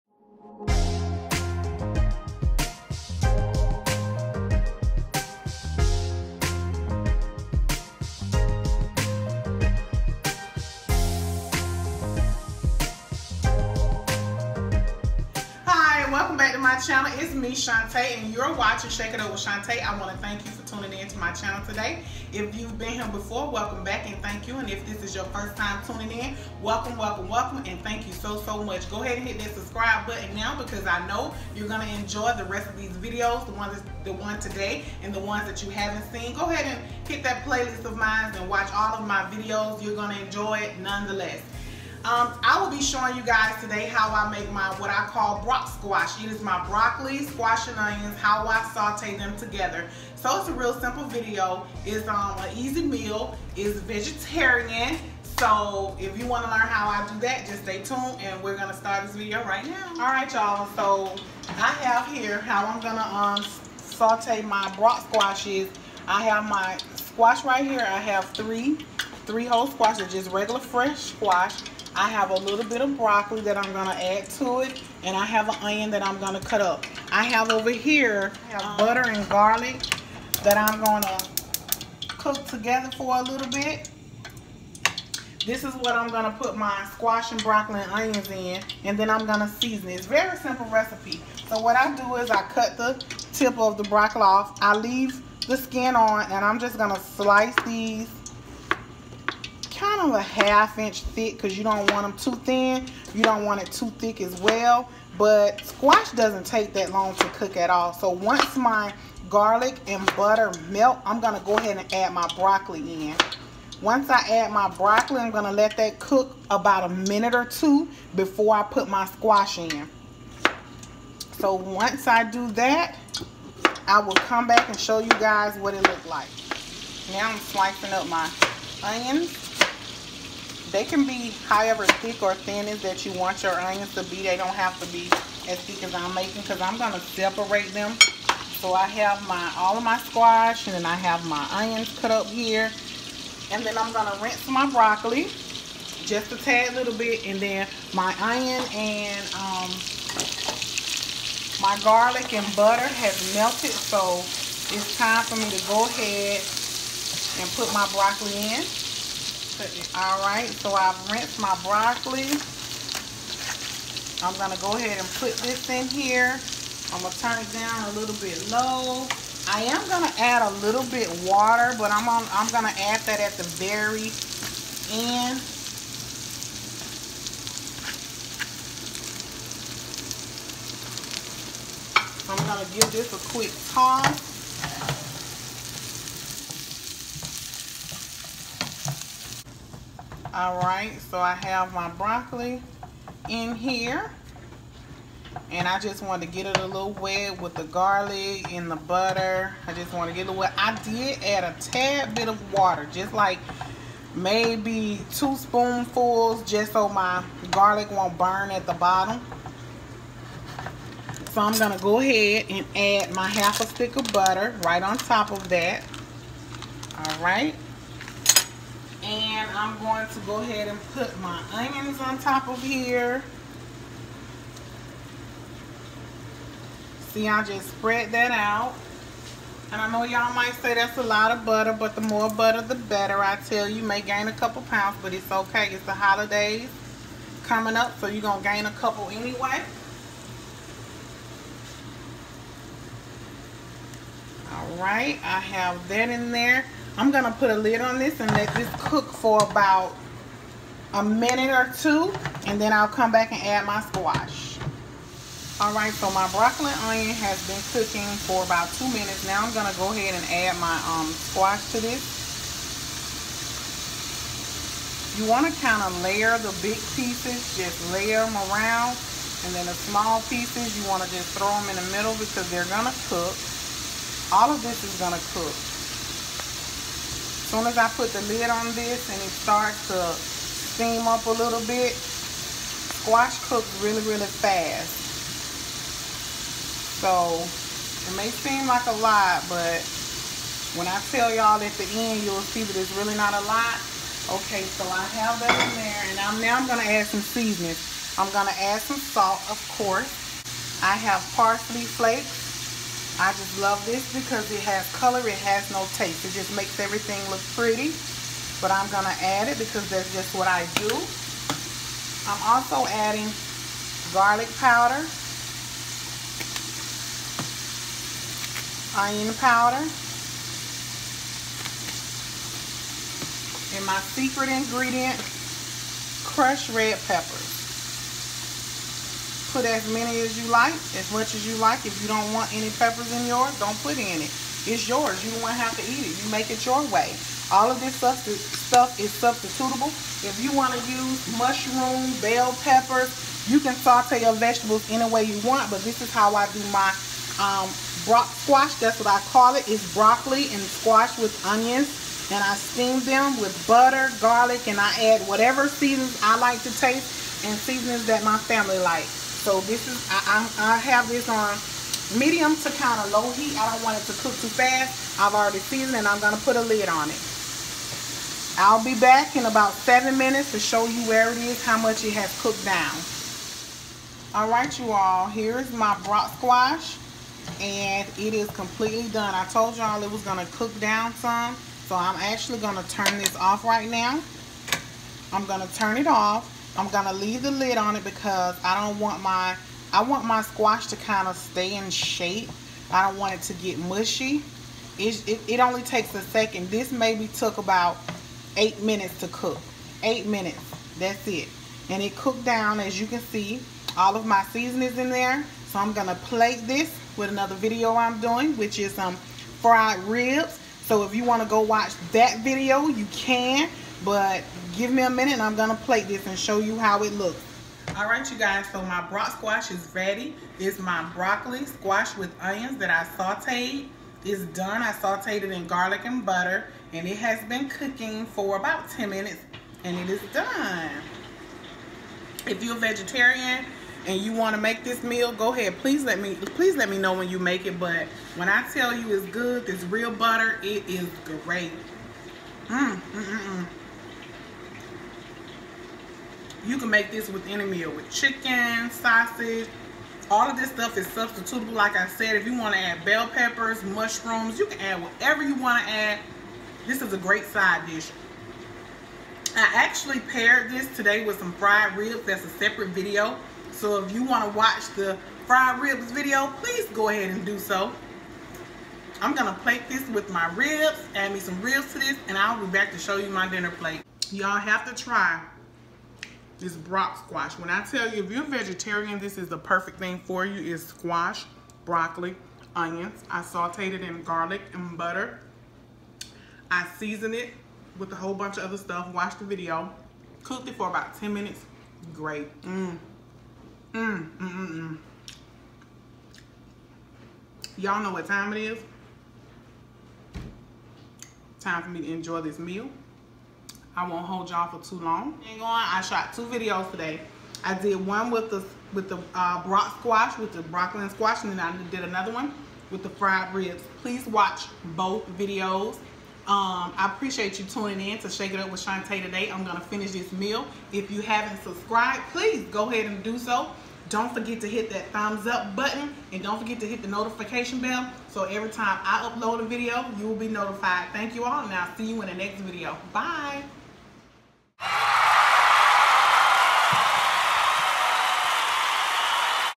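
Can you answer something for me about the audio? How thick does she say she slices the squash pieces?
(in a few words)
half inch.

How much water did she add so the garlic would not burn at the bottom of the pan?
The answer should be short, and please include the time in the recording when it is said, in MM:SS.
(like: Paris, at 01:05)
2 spoonfuls, at 03:25.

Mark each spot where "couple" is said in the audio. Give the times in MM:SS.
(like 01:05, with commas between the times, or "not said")
03:54, 03:58.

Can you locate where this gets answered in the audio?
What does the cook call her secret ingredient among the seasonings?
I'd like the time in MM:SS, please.
05:26.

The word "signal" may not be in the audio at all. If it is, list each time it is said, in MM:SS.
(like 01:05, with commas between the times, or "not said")
not said.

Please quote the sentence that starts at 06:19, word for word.
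I told y'all it was going to cook down some, so I'm actually going to turn this off right now.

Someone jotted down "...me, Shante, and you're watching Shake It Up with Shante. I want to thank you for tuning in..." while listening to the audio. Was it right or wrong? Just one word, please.
right.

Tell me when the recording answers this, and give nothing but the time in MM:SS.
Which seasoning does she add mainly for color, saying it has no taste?
05:01.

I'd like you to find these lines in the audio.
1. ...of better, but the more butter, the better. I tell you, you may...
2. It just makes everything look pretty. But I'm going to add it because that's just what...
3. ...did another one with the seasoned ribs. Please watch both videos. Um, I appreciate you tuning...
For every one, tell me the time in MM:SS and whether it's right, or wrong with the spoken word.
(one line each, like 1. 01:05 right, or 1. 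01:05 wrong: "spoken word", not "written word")
1. 03:51 wrong: "butter", not "better"
2. 05:06 right
3. 08:31 wrong: "fried", not "seasoned".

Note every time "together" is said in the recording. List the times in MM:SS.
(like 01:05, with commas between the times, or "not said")
00:49, 01:22.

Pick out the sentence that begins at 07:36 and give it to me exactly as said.
This is a great side dish.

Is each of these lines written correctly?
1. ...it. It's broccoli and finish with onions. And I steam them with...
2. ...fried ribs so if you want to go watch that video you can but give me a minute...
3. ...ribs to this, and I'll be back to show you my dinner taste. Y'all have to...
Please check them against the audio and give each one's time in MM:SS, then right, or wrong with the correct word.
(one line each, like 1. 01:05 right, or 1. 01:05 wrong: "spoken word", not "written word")
1. 05:49 wrong: "squash", not "finish"
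2. 06:49 right
3. 07:51 wrong: "plate", not "taste".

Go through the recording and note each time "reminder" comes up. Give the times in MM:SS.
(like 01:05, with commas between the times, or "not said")
not said.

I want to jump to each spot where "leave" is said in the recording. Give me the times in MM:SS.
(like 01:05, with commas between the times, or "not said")
01:34, 06:27.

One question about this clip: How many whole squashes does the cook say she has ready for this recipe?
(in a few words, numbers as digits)
3.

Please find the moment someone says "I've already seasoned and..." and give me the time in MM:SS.
06:05.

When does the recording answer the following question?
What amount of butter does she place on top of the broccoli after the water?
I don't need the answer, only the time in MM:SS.
03:33.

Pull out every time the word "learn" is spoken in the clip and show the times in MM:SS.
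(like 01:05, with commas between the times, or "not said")
00:56.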